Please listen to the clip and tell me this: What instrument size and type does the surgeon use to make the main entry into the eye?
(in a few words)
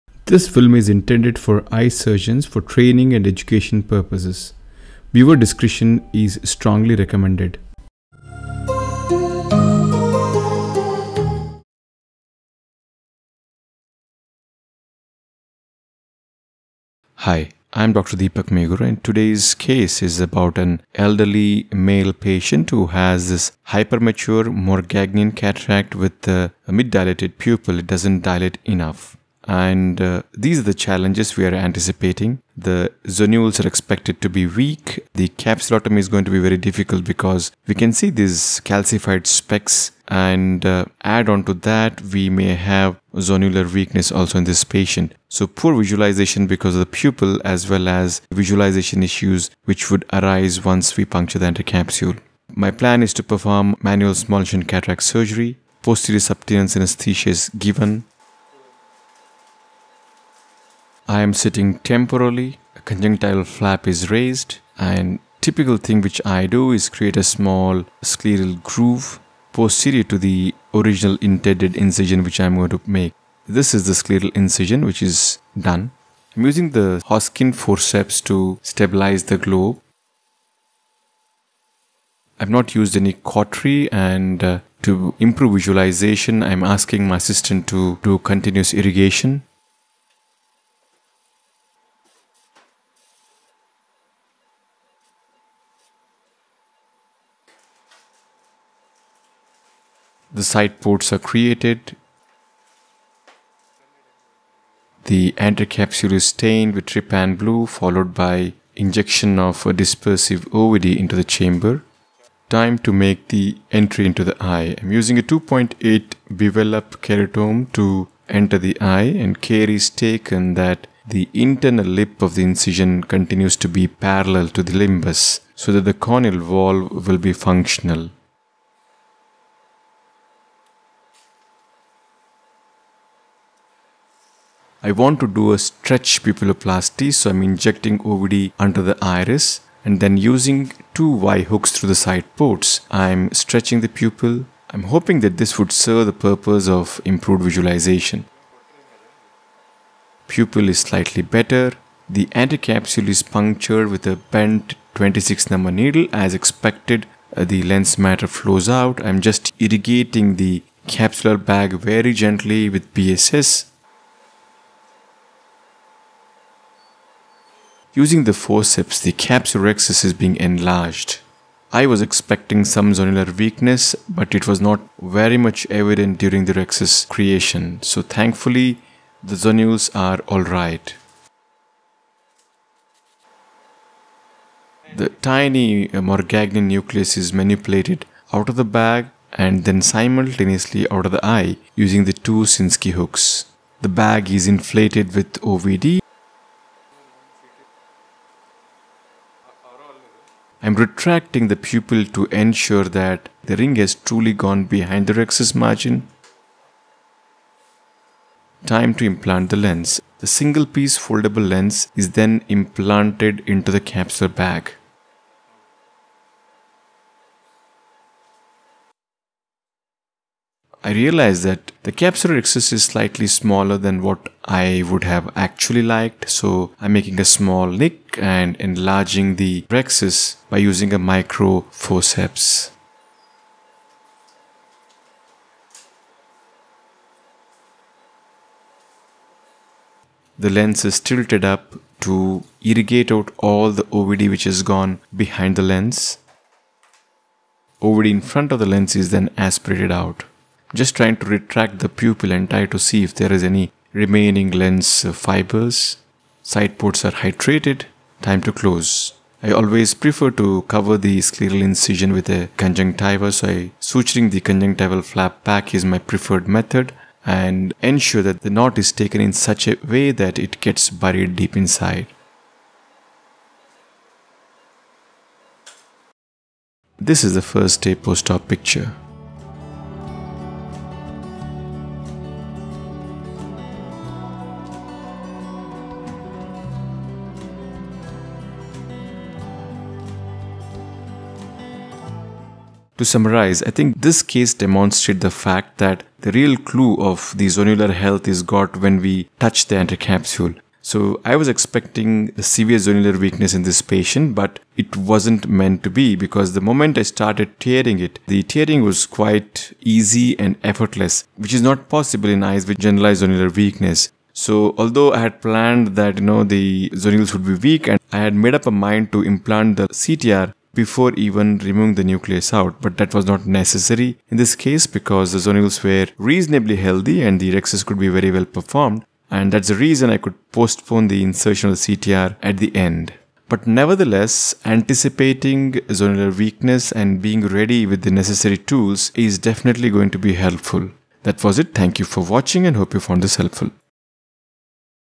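2.8 bivalve keratome.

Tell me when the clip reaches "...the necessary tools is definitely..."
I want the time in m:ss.
5:38.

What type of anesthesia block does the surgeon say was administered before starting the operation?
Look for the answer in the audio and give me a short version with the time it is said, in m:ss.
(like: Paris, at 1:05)
Posterior sub-Tenon's, at 0:55.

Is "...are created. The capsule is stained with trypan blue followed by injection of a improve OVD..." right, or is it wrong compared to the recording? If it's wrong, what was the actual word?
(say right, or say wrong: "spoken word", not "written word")
wrong: "dispersive", not "improve".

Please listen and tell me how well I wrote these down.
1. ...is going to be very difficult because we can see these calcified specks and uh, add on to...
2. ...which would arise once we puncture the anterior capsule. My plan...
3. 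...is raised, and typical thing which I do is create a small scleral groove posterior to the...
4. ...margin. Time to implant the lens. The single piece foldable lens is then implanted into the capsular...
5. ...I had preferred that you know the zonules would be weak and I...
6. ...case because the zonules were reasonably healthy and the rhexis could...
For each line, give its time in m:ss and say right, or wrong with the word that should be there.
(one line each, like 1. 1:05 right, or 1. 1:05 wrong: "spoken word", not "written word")
1. 0:35 right
2. 0:49 right
3. 1:03 right
4. 3:25 right
5. 5:15 wrong: "planned", not "preferred"
6. 5:24 right.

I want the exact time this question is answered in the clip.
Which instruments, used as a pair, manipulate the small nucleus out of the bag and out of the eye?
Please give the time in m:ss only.
3:12.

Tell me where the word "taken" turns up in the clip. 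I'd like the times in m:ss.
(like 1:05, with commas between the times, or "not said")
1:59, 4:28.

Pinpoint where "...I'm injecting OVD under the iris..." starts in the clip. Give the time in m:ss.
2:17.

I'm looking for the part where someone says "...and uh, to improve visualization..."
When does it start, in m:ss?
1:23.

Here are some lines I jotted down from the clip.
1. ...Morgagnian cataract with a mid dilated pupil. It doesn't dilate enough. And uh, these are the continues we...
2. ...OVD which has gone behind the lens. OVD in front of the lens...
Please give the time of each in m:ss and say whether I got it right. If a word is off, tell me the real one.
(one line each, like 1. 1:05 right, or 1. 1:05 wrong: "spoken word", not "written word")
1. 0:24 wrong: "challenges", not "continues"
2. 4:03 right.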